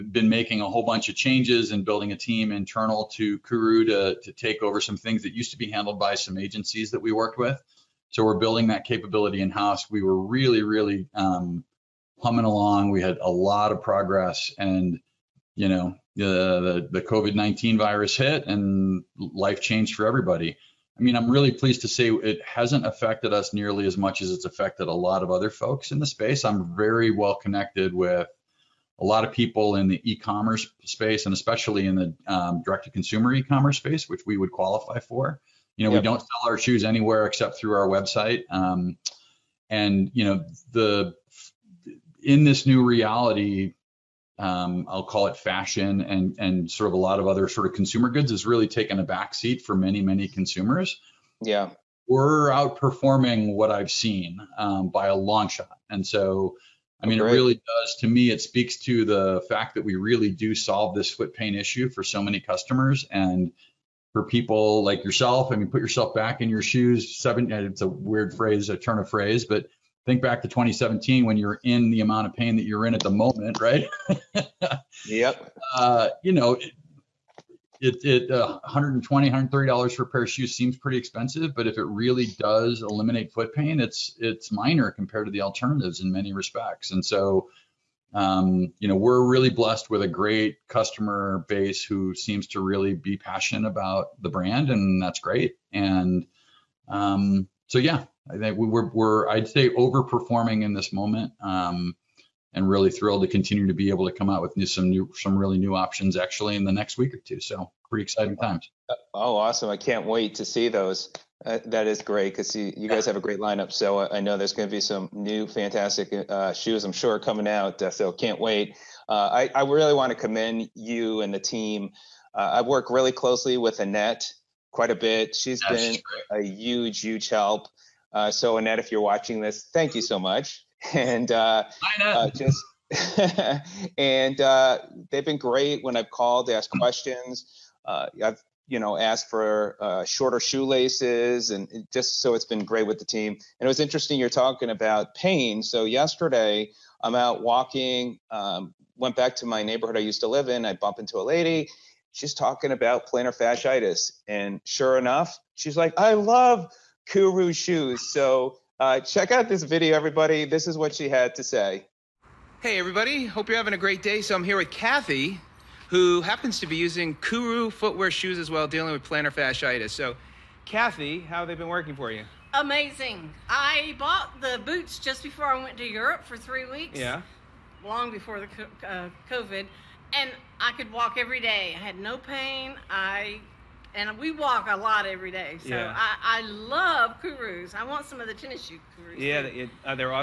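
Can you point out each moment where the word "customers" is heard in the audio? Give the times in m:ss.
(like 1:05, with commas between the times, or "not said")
1:02, 1:30.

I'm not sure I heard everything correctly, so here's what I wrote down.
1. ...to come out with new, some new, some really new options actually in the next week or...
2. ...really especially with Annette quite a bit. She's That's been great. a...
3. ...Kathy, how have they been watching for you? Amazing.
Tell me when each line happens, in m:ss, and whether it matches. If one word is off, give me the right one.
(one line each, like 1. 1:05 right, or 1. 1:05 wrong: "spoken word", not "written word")
1. 1:44 right
2. 2:02 wrong: "closely", not "especially"
3. 2:50 wrong: "working", not "watching".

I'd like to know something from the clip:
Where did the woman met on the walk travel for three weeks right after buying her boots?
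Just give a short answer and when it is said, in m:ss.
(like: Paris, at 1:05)
Europe, at 2:55.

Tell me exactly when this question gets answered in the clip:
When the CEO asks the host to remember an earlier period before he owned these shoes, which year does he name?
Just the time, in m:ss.
1:10.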